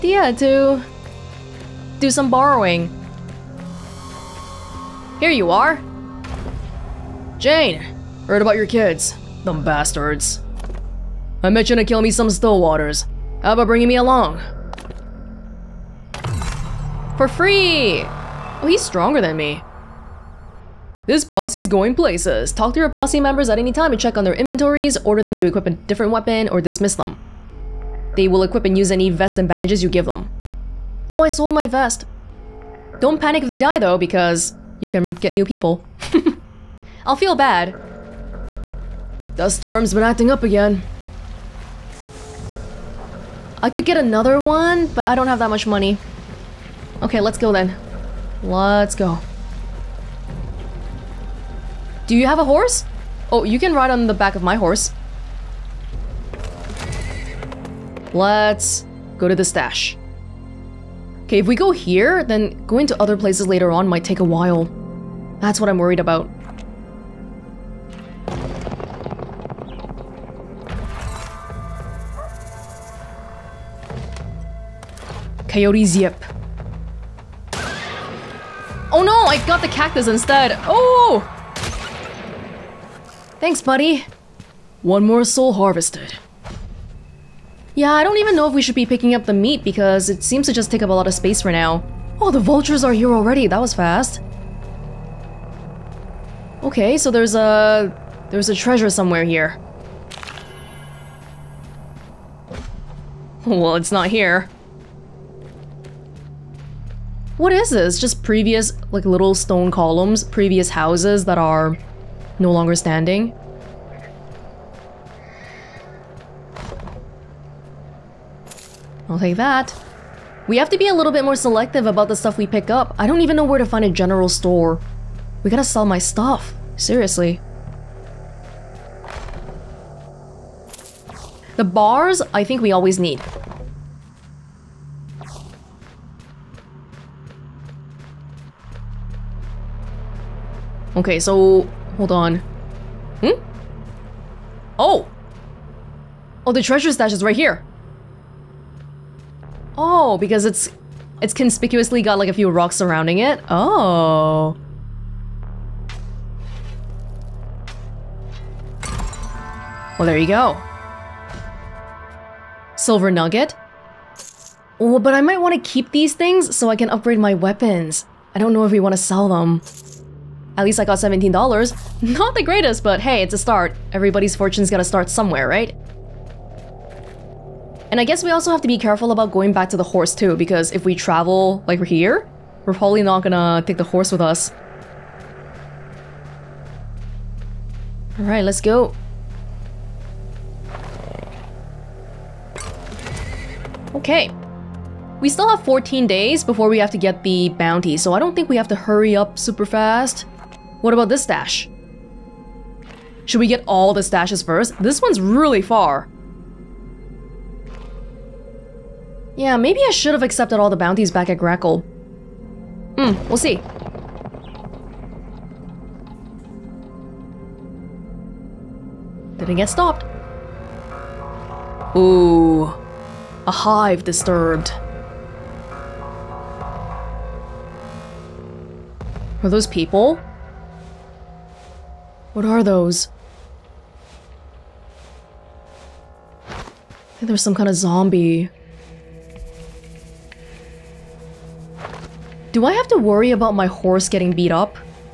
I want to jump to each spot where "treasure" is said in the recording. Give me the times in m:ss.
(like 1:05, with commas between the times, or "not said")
1:38, 2:26.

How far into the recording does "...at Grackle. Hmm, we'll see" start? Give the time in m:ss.
3:31.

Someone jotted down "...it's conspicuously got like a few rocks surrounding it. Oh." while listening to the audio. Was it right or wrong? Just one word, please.
right.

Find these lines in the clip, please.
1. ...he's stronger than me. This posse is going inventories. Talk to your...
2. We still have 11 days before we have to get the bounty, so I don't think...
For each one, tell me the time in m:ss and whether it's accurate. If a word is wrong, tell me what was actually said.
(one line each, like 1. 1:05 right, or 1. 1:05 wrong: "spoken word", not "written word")
1. 0:18 wrong: "places", not "inventories"
2. 3:15 wrong: "14", not "11".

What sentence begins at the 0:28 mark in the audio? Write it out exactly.
They will equip and use any vest and bandages you give them.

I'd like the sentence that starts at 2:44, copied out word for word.
Oh, but I might want to keep these things so I can upgrade my weapons.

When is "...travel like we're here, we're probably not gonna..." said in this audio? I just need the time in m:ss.
3:00.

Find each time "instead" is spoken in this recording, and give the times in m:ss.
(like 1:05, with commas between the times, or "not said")
1:20.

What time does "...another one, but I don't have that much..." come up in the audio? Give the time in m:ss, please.
0:43.